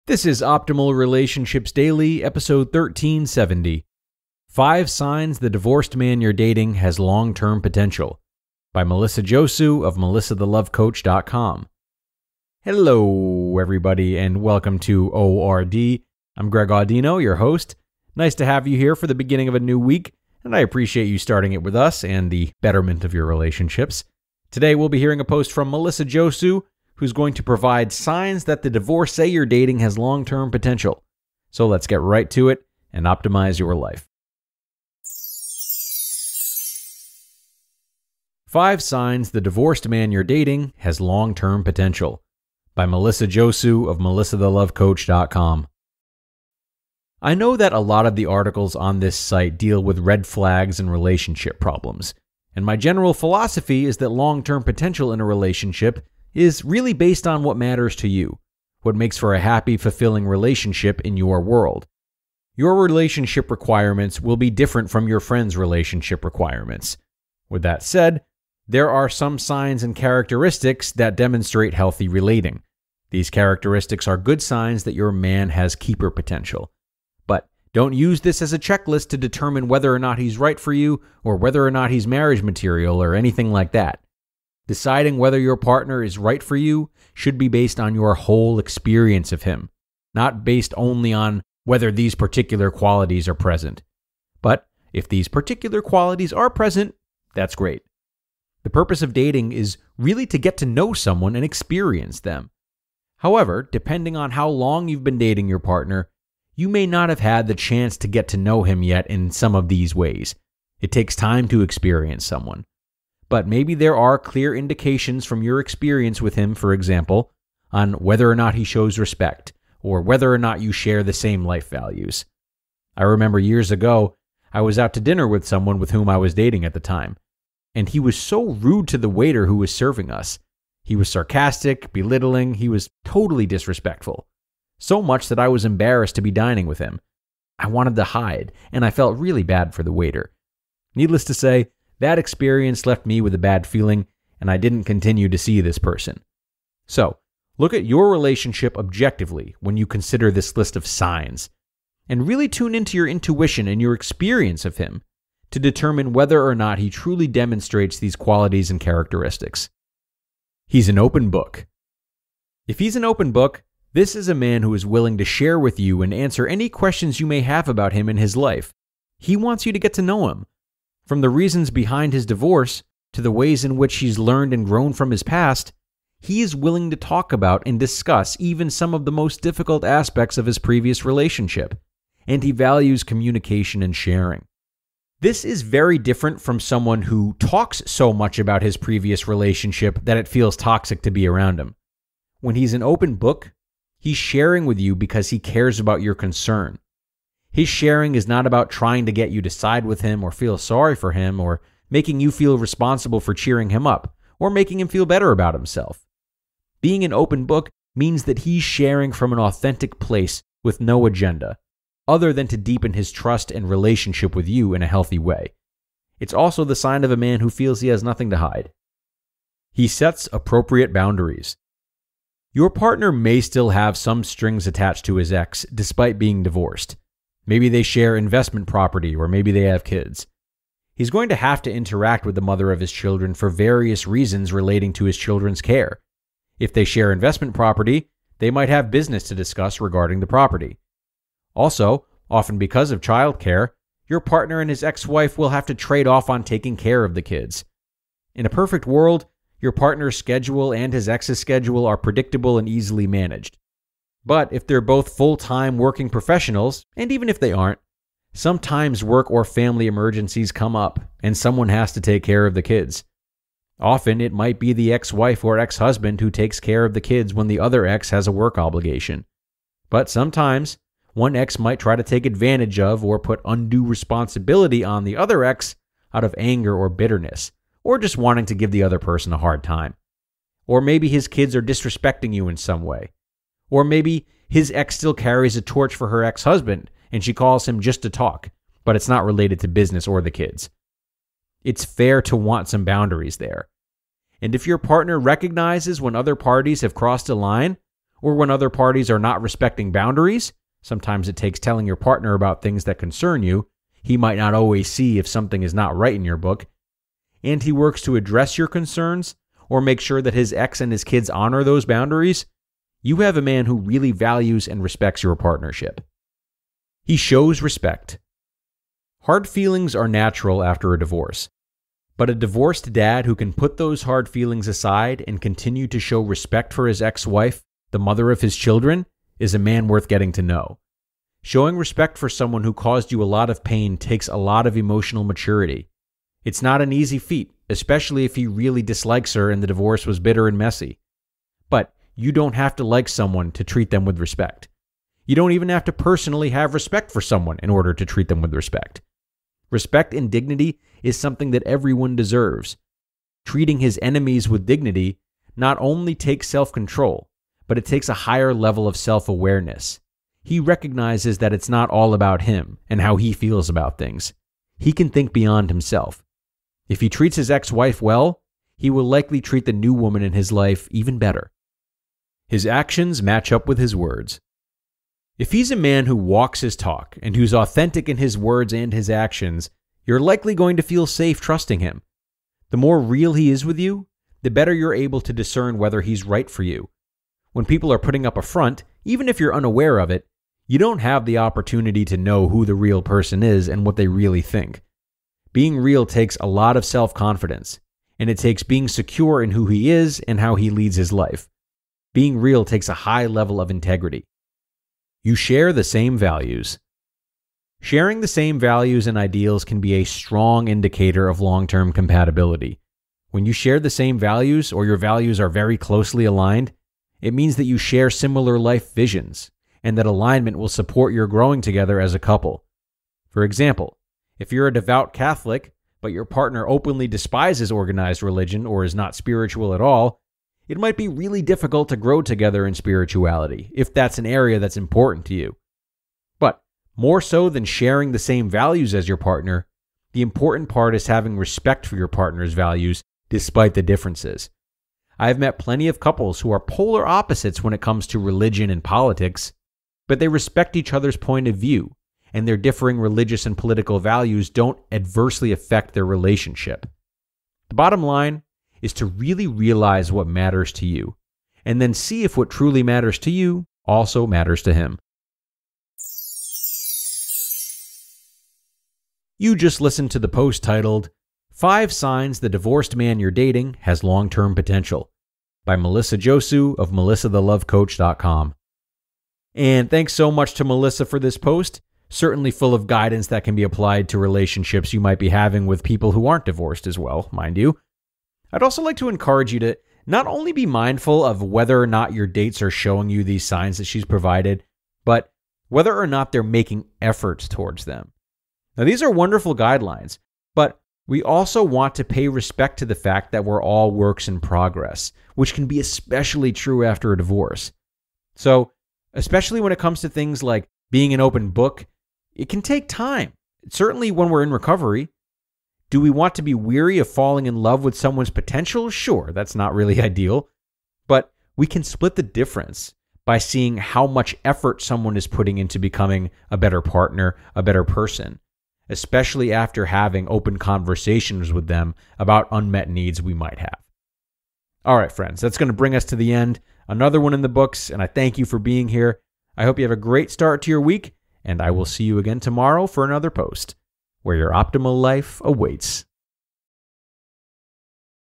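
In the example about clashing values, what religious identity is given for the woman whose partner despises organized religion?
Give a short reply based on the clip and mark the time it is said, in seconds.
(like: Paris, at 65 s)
Devout Catholic, at 424 s.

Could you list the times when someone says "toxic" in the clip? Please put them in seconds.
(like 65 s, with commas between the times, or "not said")
190 s.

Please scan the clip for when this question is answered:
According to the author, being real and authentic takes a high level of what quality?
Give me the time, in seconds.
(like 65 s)
403 s.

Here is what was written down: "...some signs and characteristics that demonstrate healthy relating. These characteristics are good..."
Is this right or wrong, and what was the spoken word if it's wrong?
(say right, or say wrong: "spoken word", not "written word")
right.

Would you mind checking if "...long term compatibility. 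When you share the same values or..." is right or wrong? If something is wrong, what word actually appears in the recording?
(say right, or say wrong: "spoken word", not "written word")
right.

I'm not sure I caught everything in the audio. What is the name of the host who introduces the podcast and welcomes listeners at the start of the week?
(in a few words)
Greg Audino.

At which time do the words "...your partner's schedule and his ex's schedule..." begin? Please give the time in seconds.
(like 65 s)
249 s.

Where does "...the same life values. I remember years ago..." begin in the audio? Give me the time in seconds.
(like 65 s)
121 s.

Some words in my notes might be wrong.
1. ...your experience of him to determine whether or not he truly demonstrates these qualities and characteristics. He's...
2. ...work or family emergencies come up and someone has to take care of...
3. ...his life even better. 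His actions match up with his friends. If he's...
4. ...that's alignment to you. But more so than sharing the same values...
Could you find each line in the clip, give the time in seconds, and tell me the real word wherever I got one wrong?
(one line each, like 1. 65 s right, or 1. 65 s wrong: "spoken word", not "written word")
1. 153 s right
2. 259 s right
3. 370 s wrong: "words", not "friends"
4. 434 s wrong: "important", not "alignment".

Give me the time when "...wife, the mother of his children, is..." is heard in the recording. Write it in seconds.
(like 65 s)
327 s.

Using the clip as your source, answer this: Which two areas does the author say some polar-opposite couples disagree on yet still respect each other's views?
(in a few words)
Religion and politics.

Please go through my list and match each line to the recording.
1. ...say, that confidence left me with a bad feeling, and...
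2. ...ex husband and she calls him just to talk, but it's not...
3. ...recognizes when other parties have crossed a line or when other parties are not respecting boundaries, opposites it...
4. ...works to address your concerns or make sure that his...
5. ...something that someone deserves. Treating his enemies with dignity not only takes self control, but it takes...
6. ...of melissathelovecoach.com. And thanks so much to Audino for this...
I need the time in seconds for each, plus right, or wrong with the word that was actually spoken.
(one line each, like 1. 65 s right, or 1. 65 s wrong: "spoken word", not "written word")
1. 141 s wrong: "experience", not "confidence"
2. 286 s right
3. 295 s wrong: "sometimes", not "opposites"
4. 307 s right
5. 351 s wrong: "everyone", not "someone"
6. 476 s wrong: "Melissa", not "Audino".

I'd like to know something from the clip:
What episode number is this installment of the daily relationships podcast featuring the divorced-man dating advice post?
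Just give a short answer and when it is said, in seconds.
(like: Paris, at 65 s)
1370, at 2 s.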